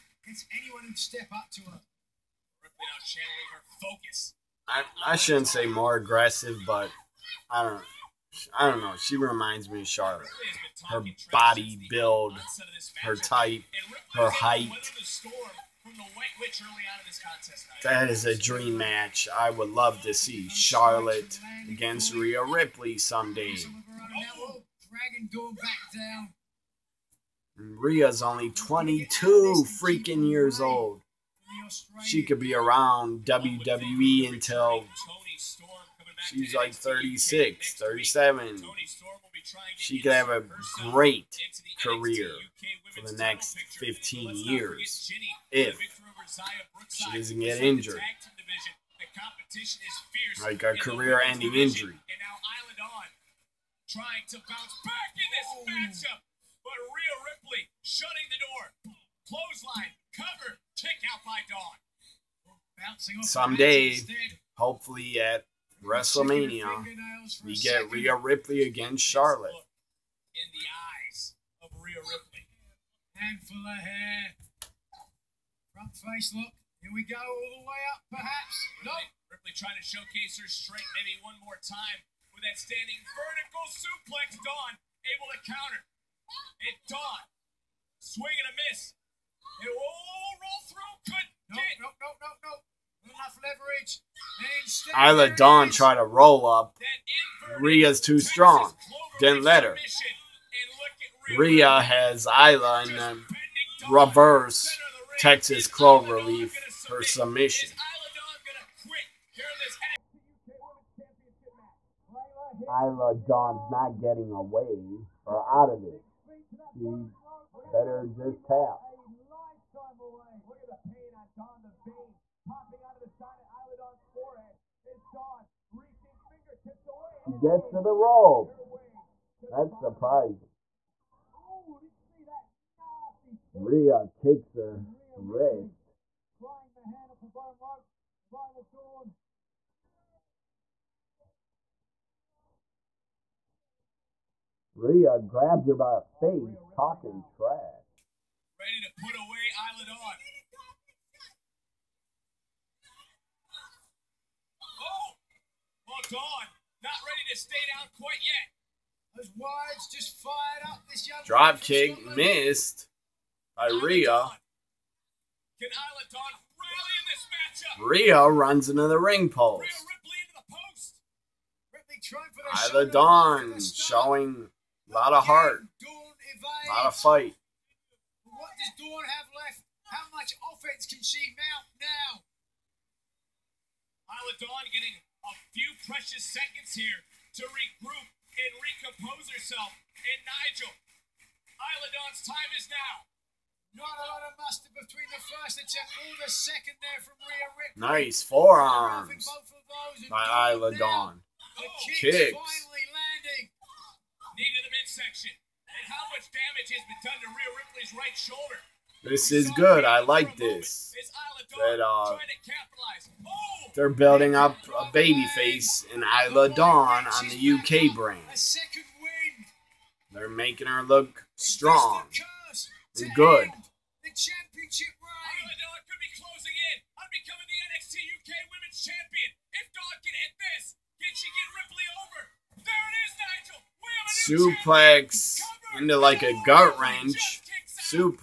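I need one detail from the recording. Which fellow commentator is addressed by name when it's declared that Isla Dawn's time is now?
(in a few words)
Nigel.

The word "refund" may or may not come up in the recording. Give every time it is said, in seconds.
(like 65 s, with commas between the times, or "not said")
not said.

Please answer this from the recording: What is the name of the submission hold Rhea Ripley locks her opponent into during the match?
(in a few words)
Reverse Texas Cloverleaf.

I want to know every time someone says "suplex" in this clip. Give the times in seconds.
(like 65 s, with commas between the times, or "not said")
83 s, 237 s.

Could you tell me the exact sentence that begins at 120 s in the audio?
Look at the pain on Dawn the vein popping the side of forehead Dawn reaching fingertips away.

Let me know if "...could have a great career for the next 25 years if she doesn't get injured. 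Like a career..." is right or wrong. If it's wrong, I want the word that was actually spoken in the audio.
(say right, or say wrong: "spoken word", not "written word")
wrong: "15", not "25".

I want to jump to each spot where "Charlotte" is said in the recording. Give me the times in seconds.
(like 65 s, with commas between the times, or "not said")
9 s, 20 s, 69 s.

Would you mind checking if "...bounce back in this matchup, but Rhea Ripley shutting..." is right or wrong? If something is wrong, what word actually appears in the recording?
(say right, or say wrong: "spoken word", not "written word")
right.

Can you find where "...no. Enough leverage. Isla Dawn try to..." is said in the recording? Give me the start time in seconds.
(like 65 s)
93 s.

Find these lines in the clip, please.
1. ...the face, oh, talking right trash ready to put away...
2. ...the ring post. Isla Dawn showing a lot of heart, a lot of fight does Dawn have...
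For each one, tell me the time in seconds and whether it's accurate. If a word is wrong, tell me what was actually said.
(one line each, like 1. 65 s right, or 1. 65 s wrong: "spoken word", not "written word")
1. 145 s right
2. 168 s right.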